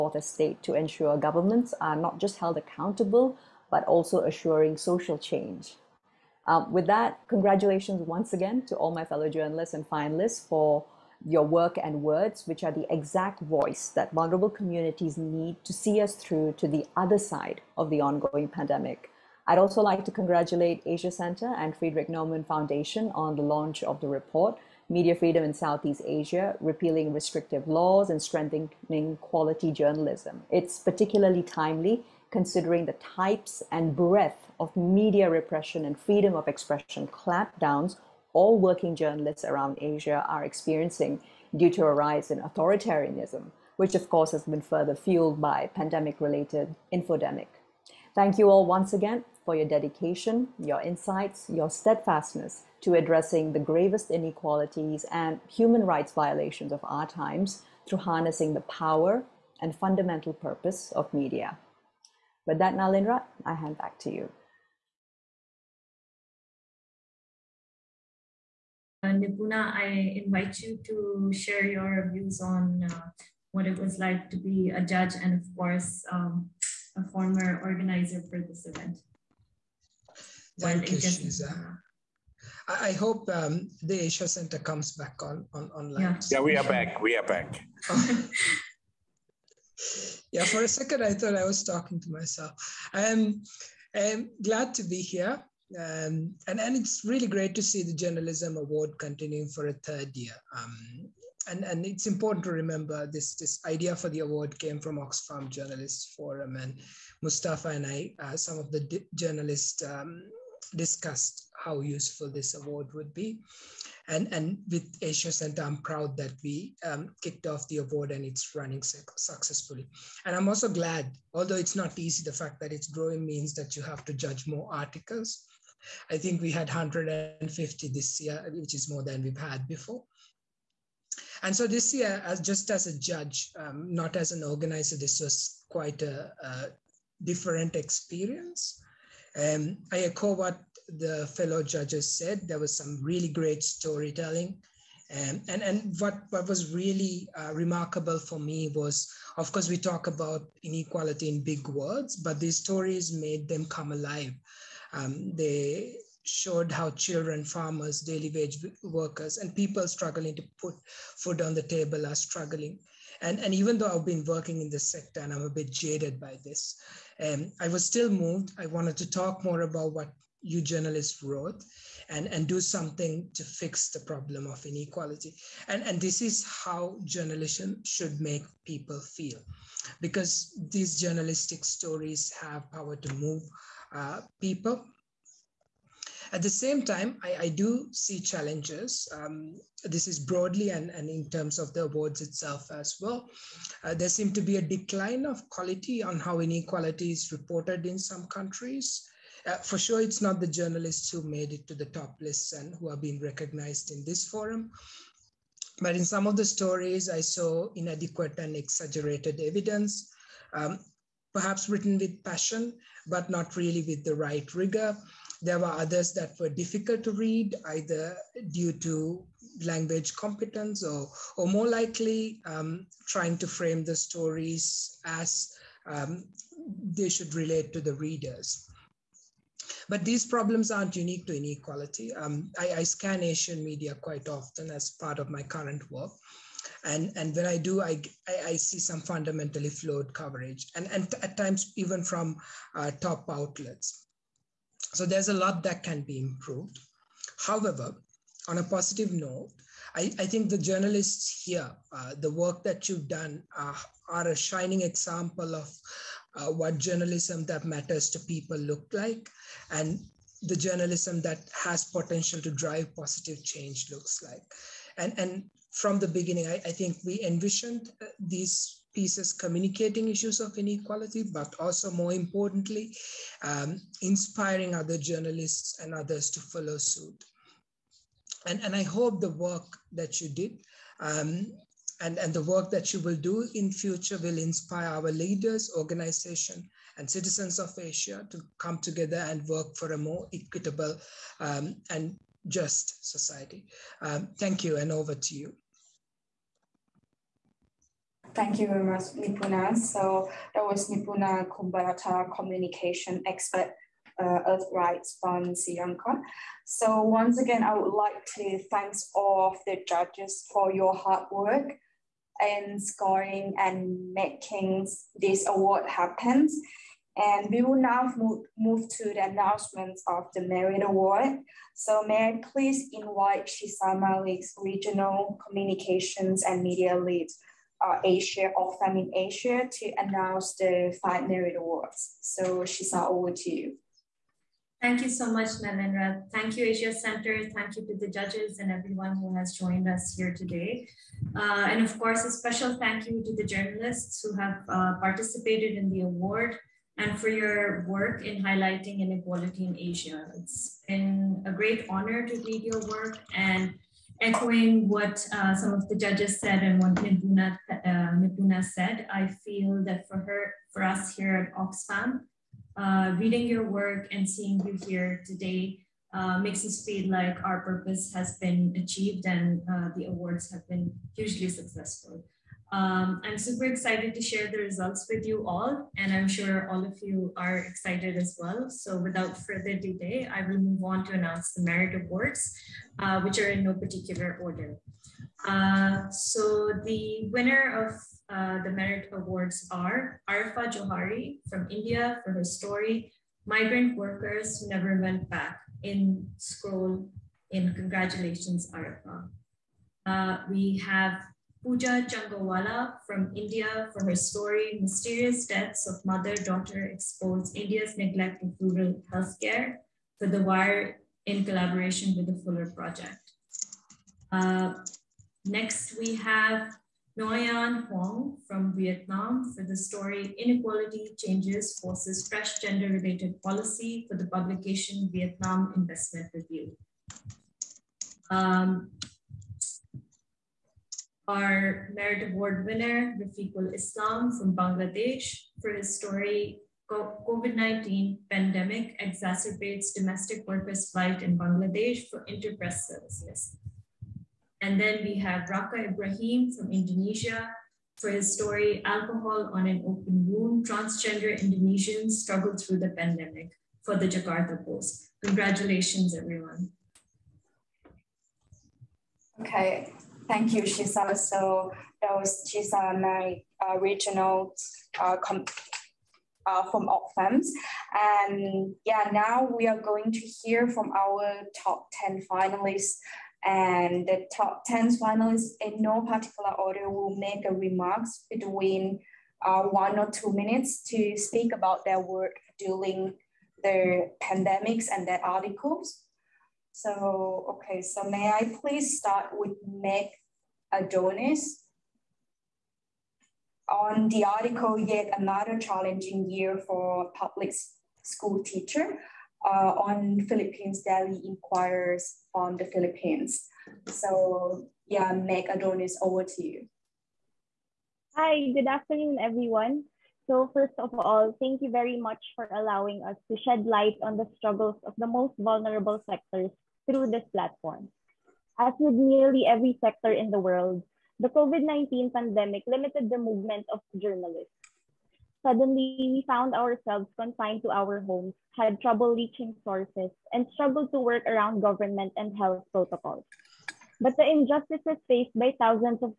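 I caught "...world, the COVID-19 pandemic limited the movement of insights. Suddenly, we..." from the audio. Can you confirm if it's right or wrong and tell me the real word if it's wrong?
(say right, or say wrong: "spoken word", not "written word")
wrong: "journalists", not "insights".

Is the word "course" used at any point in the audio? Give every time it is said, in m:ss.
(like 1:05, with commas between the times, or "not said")
0:44, 1:15, 2:29, 5:41.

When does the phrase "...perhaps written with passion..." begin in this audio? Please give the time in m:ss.
3:31.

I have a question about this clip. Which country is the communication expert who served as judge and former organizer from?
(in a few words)
Sri Lanka.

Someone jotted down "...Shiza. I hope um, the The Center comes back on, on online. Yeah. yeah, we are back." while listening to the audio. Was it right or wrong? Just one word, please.
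wrong.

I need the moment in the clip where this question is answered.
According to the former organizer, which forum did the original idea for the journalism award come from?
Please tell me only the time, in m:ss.
1:44.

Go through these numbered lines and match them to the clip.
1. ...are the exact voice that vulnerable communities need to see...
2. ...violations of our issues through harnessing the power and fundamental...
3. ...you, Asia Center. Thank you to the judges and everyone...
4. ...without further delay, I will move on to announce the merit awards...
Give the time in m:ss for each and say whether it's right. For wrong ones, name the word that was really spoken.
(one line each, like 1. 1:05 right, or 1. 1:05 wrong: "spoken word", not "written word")
1. 0:12 right
2. 0:56 wrong: "times", not "issues"
3. 5:36 right
4. 6:18 right.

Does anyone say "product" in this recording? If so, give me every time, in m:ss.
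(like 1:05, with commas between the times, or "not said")
not said.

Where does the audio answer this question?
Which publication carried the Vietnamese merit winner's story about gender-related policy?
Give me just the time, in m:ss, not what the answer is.
7:05.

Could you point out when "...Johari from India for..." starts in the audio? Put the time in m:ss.
6:30.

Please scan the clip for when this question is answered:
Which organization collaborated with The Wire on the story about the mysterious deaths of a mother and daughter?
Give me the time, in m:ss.
6:52.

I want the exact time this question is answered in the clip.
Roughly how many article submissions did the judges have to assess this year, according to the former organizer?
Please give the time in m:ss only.
2:06.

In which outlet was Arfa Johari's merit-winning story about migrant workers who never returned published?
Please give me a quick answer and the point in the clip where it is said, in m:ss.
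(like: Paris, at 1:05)
Scroll, at 6:36.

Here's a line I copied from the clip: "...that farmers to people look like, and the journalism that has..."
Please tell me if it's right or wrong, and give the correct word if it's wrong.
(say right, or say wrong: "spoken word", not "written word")
wrong: "matters", not "farmers".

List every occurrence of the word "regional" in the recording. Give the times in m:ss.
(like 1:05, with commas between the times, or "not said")
5:24, 7:43.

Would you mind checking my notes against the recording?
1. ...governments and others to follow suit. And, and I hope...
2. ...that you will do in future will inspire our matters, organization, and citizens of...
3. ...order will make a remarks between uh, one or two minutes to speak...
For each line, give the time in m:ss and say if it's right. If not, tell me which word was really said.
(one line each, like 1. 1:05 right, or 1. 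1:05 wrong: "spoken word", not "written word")
1. 4:34 wrong: "journalists", not "governments"
2. 4:42 wrong: "leaders", not "matters"
3. 7:56 right.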